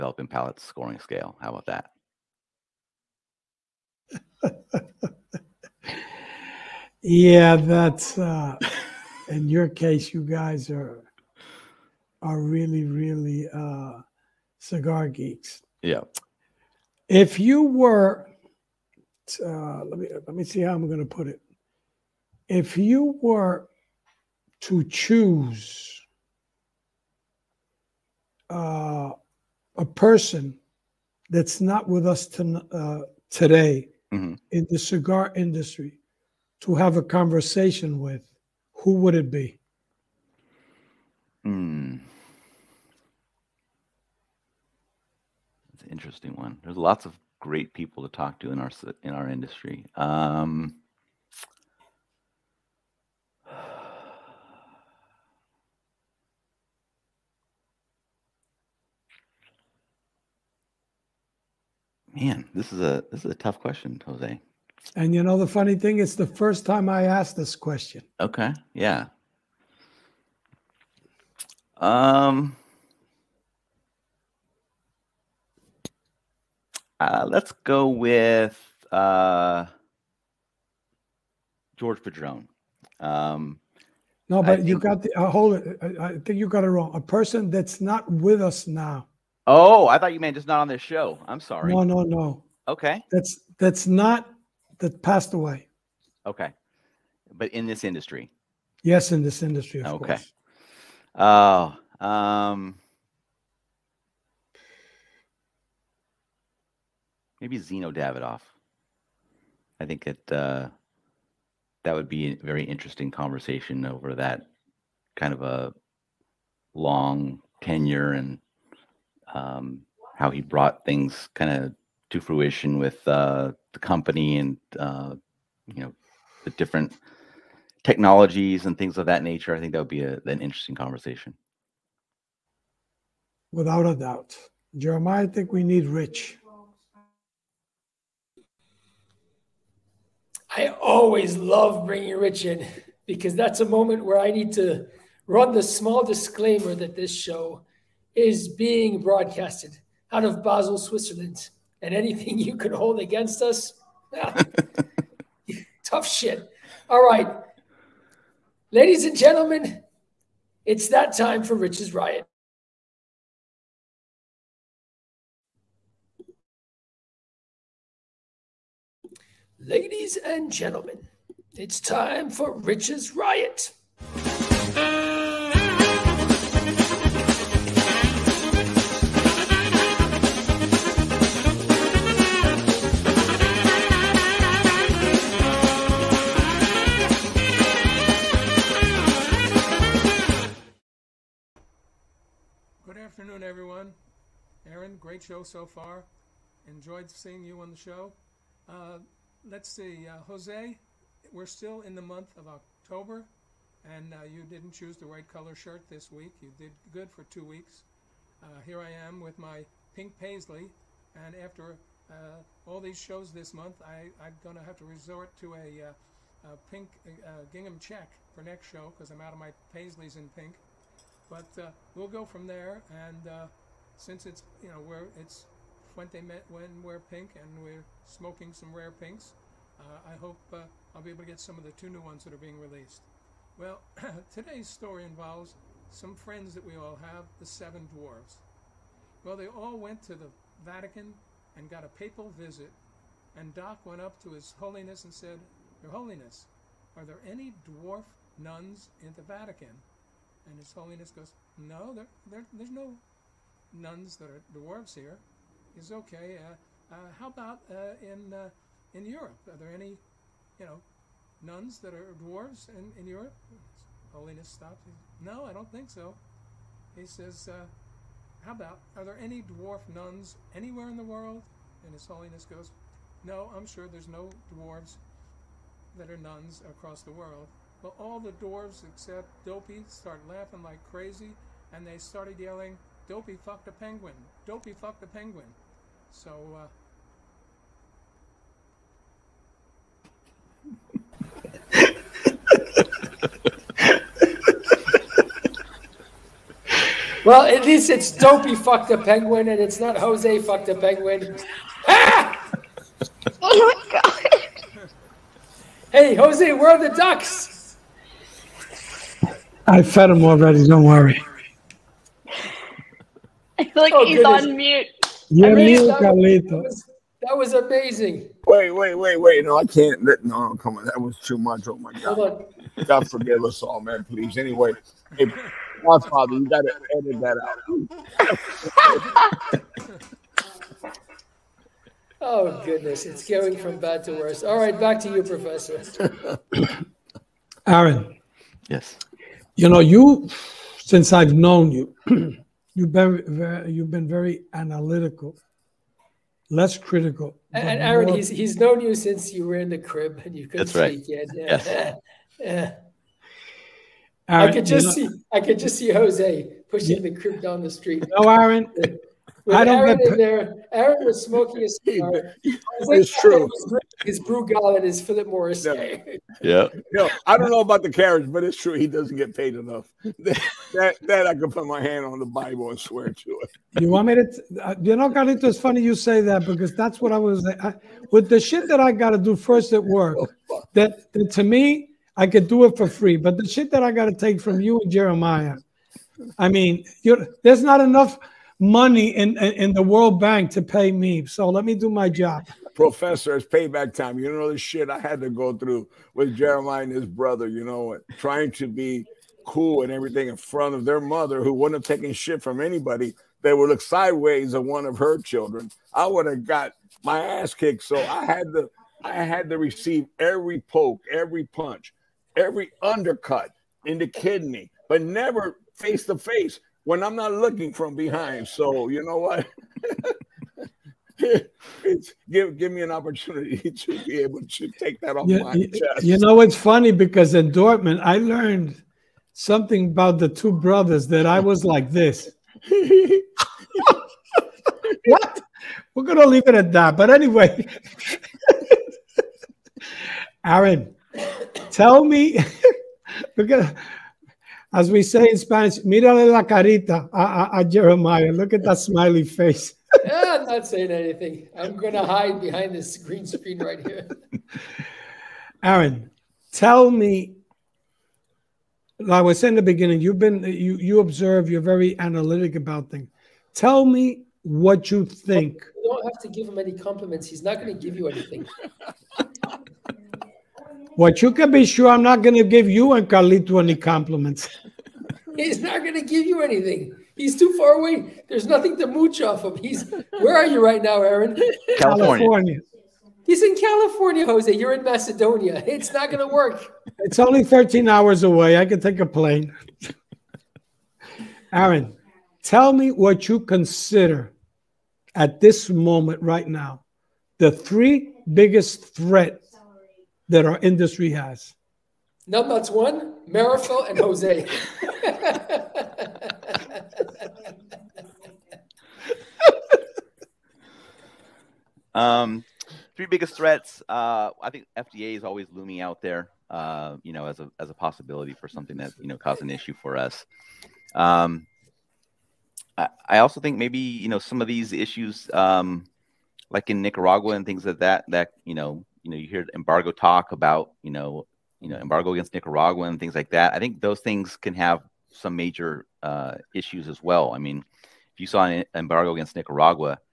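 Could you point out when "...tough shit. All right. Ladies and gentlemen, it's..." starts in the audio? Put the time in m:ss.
2:35.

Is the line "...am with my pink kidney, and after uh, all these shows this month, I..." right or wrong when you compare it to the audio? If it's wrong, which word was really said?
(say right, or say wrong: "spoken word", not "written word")
wrong: "paisley", not "kidney".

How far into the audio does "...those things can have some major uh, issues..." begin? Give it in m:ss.
8:53.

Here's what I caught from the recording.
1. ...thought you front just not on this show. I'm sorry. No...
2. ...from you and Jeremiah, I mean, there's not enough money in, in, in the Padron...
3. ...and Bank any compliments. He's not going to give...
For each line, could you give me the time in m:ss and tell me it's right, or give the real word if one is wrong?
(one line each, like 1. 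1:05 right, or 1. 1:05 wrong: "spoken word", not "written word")
1. 1:29 wrong: "meant", not "front"
2. 6:24 wrong: "World", not "Padron"
3. 7:52 wrong: "Carlito", not "Bank".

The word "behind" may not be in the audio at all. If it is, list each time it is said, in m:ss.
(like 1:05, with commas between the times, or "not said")
6:57, 7:32.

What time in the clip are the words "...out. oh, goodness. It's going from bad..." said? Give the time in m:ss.
5:28.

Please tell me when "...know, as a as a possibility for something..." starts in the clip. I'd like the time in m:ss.
8:37.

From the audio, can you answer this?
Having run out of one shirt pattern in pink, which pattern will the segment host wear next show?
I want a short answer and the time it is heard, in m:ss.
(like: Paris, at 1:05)
gingham check, at 3:37.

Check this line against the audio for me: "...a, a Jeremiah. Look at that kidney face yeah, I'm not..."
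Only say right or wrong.
wrong.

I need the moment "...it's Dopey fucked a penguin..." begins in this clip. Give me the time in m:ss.
4:57.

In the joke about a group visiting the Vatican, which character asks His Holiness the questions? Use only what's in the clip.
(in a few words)
Doc.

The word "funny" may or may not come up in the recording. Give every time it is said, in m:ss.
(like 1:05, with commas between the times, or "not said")
1:05, 6:15, 7:06.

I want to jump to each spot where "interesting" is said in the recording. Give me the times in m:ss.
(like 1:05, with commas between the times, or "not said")
0:45, 1:52, 2:10.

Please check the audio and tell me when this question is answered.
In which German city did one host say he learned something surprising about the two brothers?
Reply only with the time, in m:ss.
7:07.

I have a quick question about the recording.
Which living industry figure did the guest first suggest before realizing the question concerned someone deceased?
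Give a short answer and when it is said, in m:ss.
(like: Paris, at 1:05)
George Padron, at 1:21.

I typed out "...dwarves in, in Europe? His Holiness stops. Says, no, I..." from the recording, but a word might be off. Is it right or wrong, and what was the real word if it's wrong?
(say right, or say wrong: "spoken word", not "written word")
right.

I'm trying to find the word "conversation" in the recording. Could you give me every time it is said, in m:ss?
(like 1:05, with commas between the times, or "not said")
0:37, 1:53, 2:10.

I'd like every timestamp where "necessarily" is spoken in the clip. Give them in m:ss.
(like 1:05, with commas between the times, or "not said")
not said.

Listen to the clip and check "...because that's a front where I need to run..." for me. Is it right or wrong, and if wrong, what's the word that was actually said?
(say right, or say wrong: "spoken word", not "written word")
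wrong: "moment", not "front".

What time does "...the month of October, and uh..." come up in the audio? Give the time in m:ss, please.
3:21.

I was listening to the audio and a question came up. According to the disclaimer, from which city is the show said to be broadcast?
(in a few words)
Basel, Switzerland.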